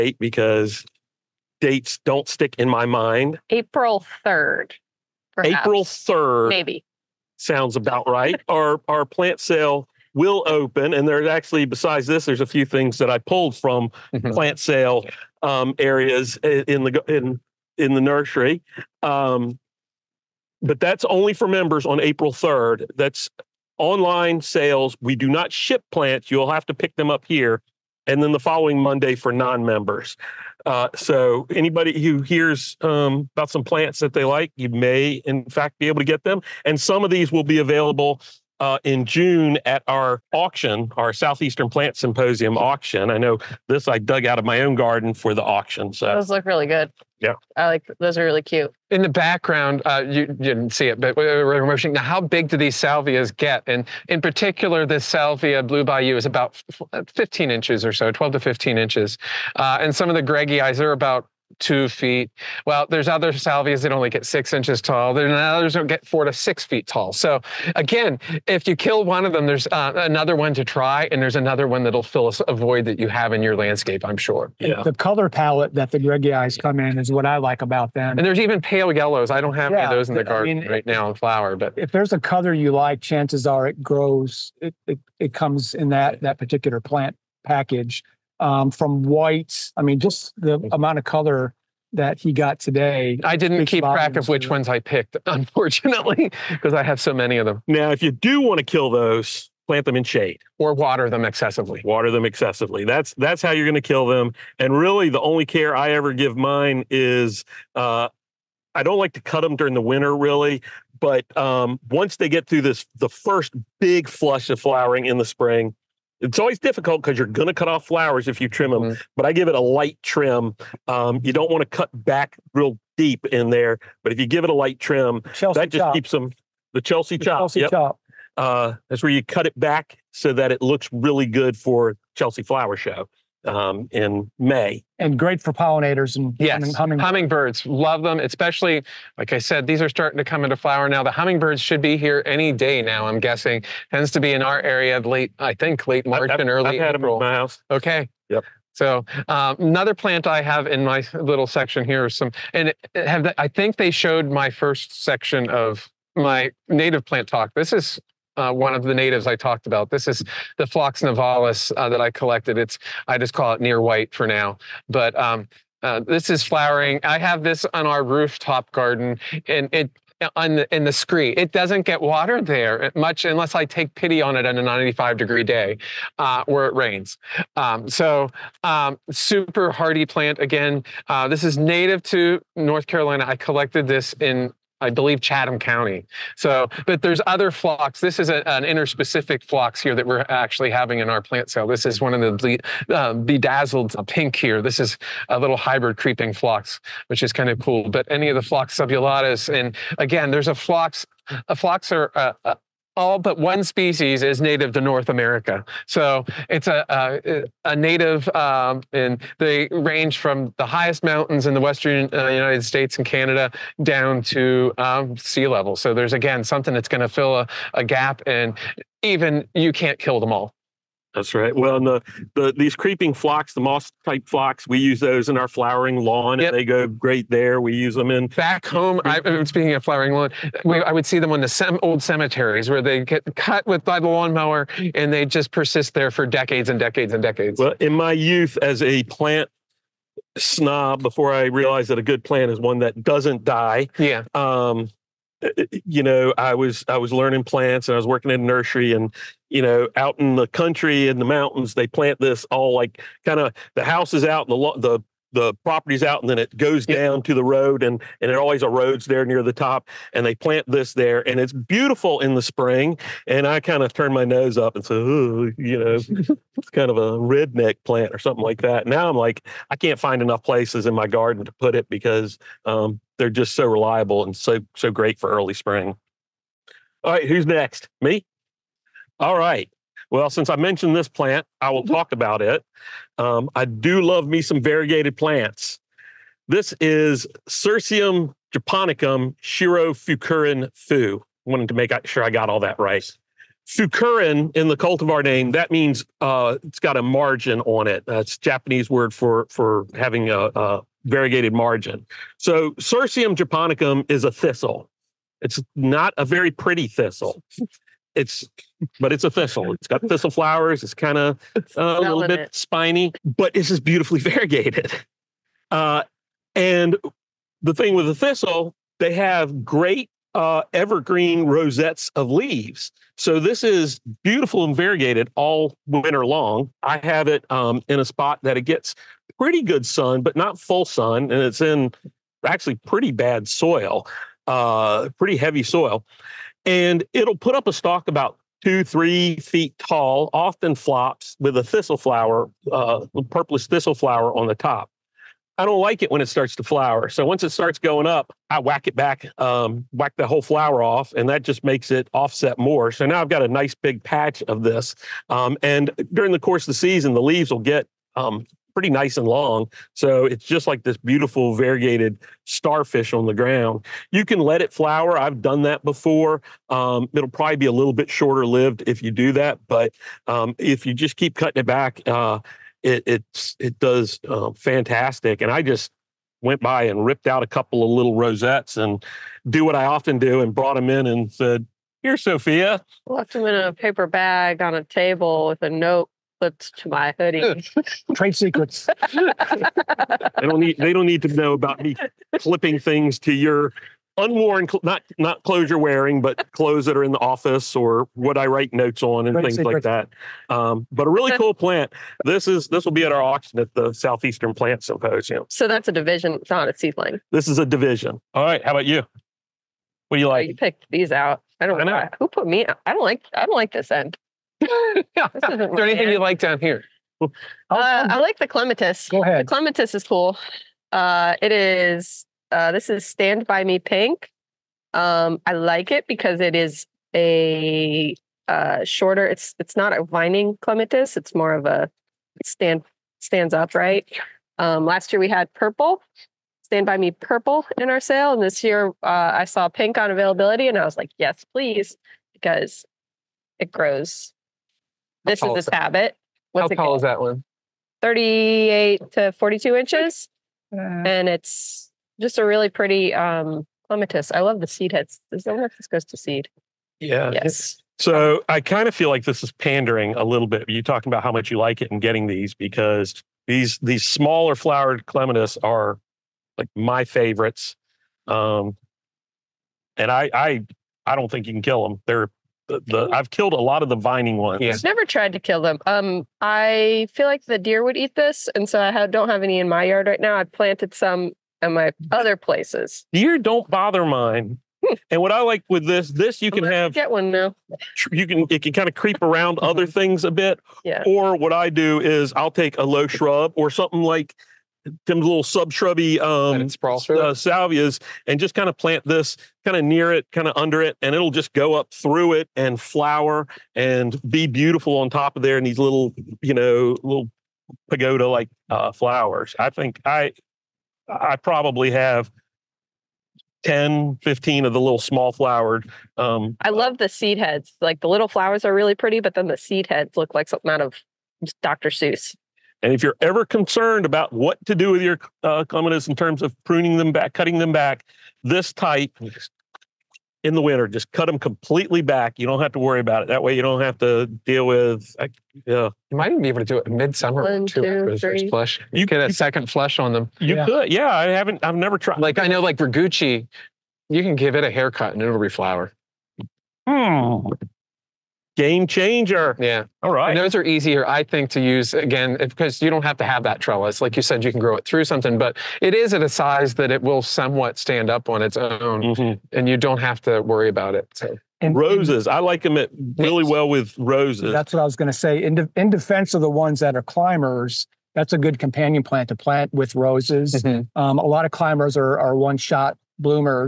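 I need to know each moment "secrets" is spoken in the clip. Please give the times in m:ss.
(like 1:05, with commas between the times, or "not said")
6:28, 6:39.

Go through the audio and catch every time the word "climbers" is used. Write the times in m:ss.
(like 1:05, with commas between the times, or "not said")
9:27, 9:31.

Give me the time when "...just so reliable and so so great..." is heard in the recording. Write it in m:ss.
4:33.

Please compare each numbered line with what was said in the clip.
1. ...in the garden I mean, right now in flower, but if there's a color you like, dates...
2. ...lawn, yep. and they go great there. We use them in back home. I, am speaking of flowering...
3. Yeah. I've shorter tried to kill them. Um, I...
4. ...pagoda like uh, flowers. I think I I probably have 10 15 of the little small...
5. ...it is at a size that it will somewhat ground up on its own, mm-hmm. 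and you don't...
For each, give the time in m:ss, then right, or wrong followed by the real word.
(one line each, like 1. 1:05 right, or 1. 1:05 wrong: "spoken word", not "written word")
1. 1:20 wrong: "chances", not "dates"
2. 3:45 right
3. 7:54 wrong: "never", not "shorter"
4. 8:27 right
5. 9:15 wrong: "stand", not "ground".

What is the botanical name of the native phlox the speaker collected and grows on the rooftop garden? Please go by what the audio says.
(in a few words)
Phlox nivalis.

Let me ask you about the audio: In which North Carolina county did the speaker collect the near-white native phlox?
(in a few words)
Chatham County.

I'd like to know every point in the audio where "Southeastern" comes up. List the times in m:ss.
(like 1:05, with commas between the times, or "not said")
0:41, 6:43.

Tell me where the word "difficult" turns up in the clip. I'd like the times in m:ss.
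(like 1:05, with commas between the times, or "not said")
1:56.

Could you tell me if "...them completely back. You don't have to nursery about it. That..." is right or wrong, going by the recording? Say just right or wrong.
wrong.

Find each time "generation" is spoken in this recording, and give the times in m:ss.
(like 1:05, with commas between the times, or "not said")
not said.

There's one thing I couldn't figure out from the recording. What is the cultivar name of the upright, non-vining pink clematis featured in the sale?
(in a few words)
Stand by Me Pink.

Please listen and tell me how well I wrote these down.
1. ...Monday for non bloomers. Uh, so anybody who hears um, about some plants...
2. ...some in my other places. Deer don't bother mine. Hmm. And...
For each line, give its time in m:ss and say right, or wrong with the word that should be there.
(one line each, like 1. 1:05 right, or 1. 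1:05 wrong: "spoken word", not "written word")
1. 0:28 wrong: "members", not "bloomers"
2. 8:00 right.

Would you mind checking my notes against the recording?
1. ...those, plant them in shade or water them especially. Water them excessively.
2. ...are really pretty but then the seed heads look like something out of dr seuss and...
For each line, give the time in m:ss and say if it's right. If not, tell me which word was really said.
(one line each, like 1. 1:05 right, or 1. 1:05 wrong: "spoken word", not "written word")
1. 1:38 wrong: "excessively", not "especially"
2. 8:38 right.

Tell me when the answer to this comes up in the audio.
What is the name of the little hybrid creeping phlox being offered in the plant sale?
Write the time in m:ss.
3:13.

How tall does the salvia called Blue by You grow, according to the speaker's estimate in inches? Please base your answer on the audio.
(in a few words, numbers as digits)
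12 to 15 inches.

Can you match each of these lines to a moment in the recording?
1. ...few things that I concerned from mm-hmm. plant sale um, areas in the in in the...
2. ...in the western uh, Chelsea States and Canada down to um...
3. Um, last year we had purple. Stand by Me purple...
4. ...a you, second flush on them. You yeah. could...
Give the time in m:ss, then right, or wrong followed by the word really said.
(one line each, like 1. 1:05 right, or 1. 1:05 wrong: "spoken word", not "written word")
1. 0:12 wrong: "pulled", not "concerned"
2. 3:31 wrong: "United", not "Chelsea"
3. 7:14 right
4. 8:59 right.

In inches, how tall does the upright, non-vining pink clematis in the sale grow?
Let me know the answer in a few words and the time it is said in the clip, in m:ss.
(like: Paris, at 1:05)
38 to 42 inches, at 7:28.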